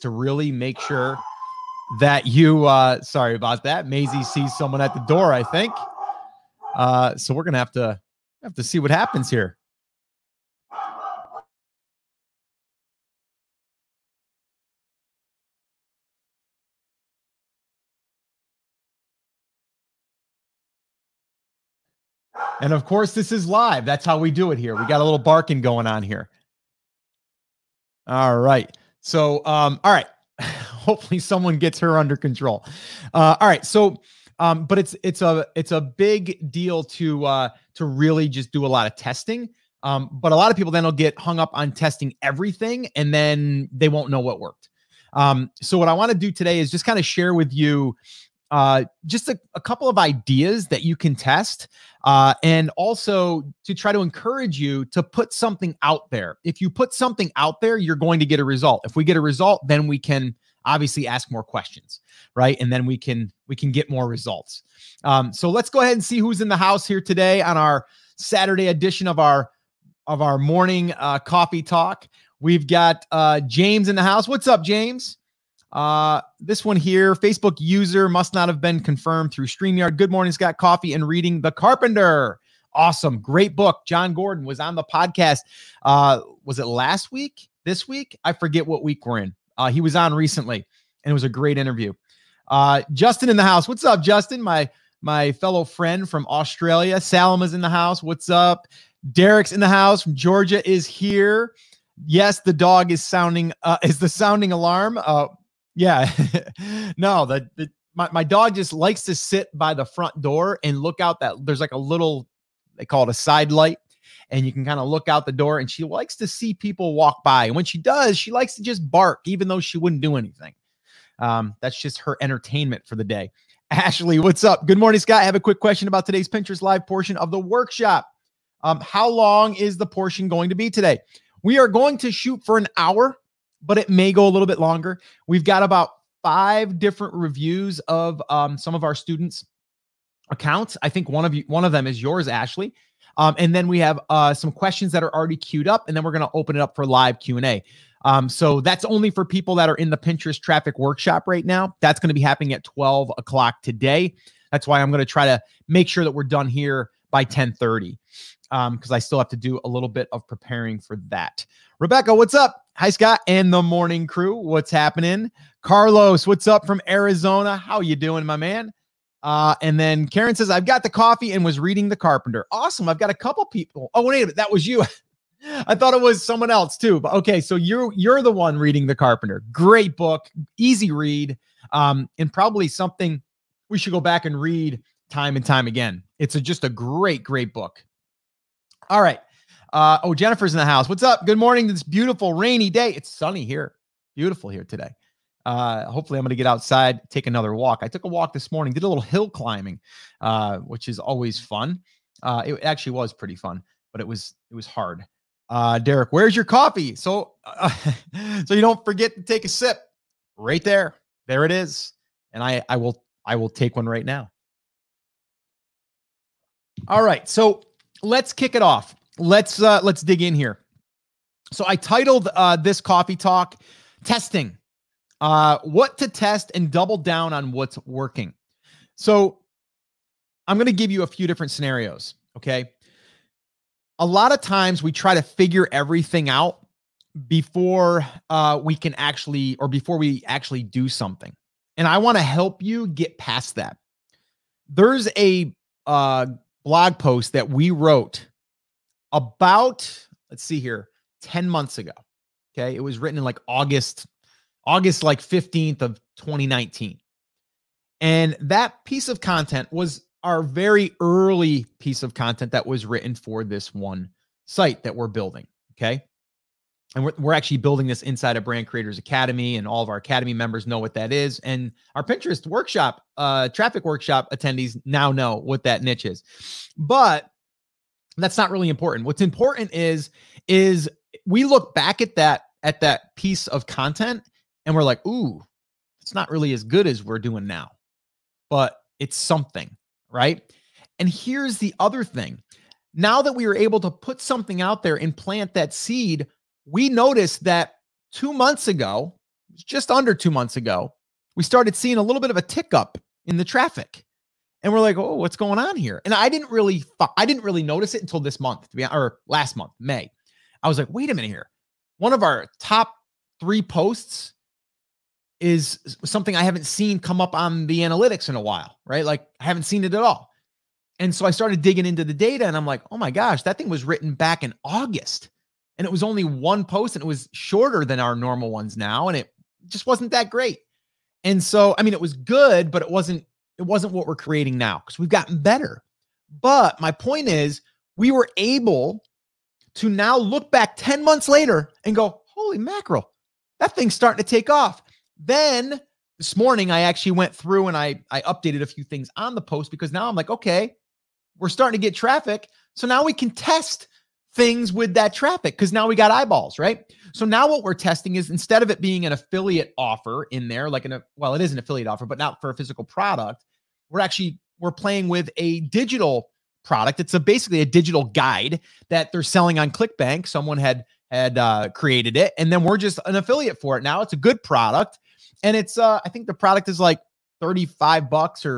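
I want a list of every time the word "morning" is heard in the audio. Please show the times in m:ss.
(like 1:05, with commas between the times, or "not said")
1:10, 1:20, 2:04, 2:43, 3:11, 3:18, 5:46.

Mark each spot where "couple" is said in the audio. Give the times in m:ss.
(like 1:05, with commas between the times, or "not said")
0:49, 2:53.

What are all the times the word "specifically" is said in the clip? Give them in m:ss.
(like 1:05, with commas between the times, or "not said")
not said.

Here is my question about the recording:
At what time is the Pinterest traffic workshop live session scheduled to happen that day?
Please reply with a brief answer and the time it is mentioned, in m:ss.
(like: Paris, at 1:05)
12 o'clock, at 2:32.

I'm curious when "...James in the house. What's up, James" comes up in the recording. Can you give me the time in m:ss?
1:13.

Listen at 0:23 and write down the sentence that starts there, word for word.
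That's how we do it here.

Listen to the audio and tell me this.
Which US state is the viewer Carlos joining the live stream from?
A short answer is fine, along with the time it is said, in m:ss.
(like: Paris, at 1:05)
Arizona, at 2:46.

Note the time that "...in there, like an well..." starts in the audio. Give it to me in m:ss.
6:00.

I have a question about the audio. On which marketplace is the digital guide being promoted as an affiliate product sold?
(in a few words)
ClickBank.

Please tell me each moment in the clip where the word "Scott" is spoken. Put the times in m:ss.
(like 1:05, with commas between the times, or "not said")
1:20, 2:04, 2:42.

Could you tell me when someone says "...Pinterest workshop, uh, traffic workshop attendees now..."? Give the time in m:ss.
4:32.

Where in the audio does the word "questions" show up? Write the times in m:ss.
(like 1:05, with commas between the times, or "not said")
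1:01, 2:05, 2:24.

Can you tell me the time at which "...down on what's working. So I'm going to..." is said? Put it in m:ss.
3:46.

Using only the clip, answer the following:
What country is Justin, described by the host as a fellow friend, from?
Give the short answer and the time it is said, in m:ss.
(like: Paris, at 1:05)
Australia, at 1:36.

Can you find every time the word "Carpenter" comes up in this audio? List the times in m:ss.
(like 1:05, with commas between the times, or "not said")
1:21, 2:51, 2:58.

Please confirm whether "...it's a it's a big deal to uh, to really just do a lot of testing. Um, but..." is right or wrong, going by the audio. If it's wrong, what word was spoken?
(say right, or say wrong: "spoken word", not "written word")
right.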